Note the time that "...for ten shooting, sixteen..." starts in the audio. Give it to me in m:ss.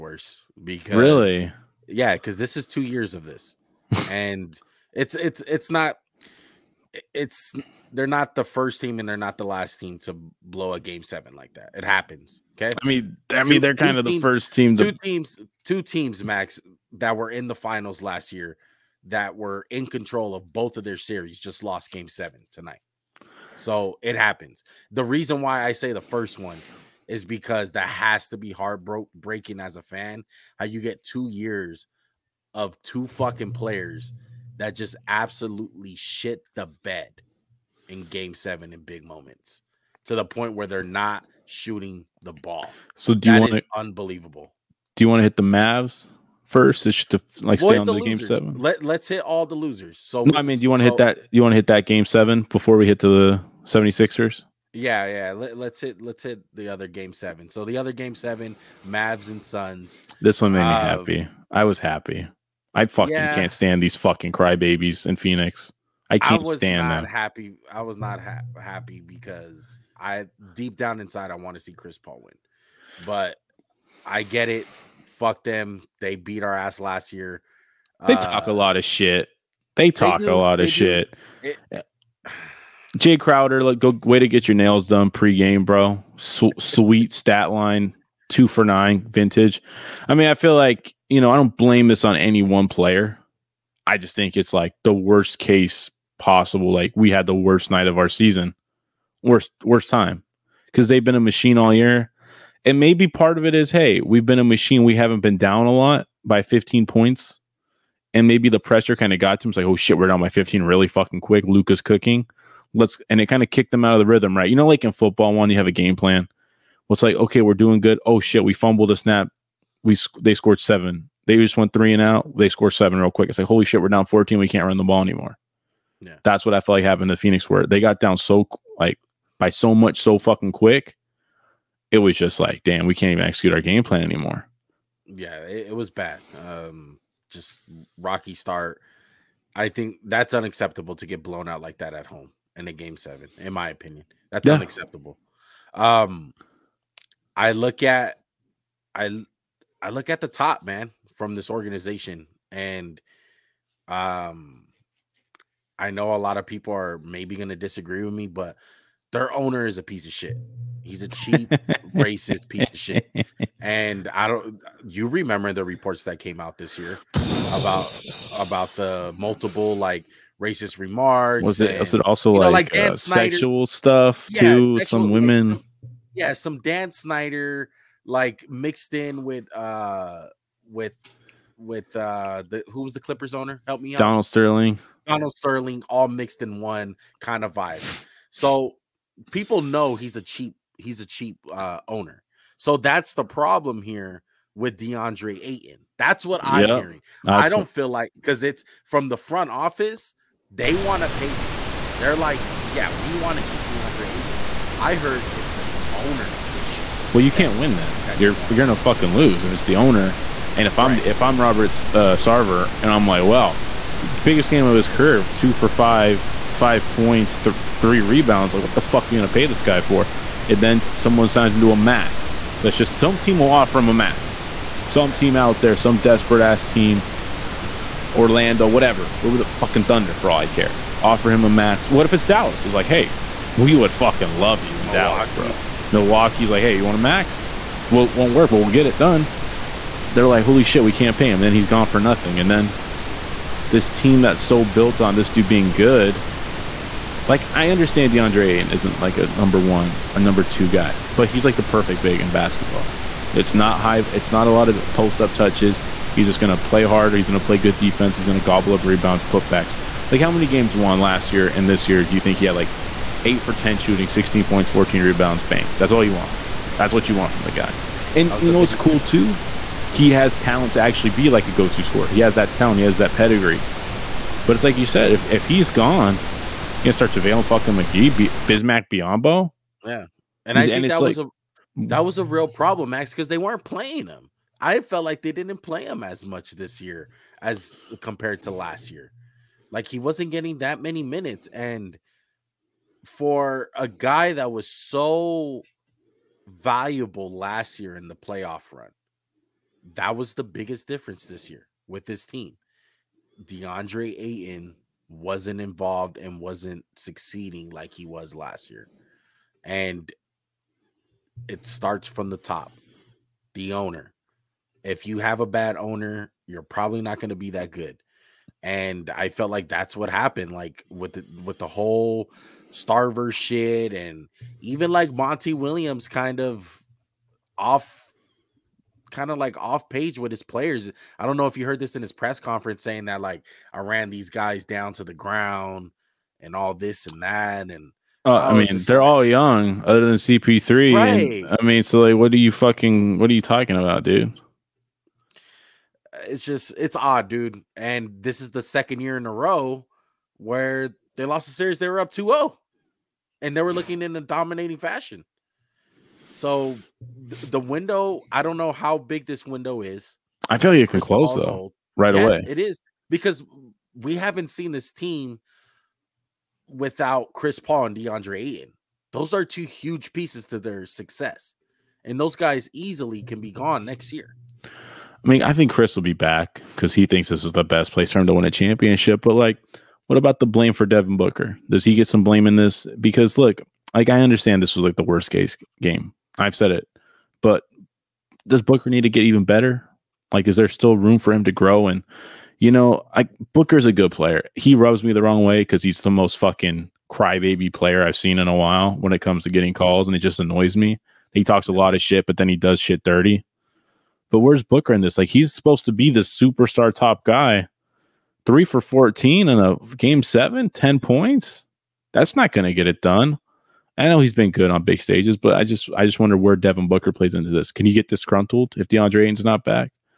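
4:23.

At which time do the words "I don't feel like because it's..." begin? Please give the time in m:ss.
3:17.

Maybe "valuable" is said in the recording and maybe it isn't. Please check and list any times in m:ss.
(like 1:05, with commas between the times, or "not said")
4:56.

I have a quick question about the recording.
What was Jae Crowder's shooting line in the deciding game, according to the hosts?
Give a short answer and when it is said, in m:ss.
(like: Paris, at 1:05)
2 for 9, at 1:28.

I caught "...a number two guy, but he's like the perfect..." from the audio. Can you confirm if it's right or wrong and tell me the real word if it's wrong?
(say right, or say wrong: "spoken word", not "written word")
right.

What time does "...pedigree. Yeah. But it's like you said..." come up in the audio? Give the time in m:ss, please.
4:33.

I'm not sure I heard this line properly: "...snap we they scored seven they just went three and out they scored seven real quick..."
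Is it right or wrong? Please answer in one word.
right.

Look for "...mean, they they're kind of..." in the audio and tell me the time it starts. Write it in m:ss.
0:13.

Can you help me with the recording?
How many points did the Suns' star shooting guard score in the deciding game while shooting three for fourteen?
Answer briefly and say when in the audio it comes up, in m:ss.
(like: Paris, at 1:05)
10, at 6:50.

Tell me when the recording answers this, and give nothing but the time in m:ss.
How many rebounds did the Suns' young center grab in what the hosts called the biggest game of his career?
3:37.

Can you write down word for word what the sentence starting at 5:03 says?
DeAndre Ayton wasn't involved and wasn't succeeding like he was last year.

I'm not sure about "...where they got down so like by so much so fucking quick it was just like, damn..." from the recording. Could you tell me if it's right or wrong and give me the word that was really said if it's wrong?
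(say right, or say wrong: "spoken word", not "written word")
right.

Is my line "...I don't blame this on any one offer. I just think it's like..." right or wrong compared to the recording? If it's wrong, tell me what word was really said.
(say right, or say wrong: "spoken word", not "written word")
wrong: "player", not "offer".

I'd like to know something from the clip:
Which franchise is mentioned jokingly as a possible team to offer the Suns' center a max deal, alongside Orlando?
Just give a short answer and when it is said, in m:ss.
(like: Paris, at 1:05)
Thunder, at 3:49.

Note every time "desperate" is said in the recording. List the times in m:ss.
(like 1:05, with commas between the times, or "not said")
3:45.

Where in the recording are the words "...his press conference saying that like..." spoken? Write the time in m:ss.
5:32.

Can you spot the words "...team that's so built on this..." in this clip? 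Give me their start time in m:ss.
4:03.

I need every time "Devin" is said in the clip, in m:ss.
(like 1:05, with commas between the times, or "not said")
6:20, 6:56.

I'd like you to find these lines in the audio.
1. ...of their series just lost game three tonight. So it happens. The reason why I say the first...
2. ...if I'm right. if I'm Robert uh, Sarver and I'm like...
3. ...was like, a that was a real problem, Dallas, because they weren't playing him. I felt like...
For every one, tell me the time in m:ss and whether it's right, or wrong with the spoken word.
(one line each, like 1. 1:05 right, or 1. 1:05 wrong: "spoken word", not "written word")
1. 0:20 wrong: "seven", not "three"
2. 3:30 right
3. 4:41 wrong: "Max", not "Dallas".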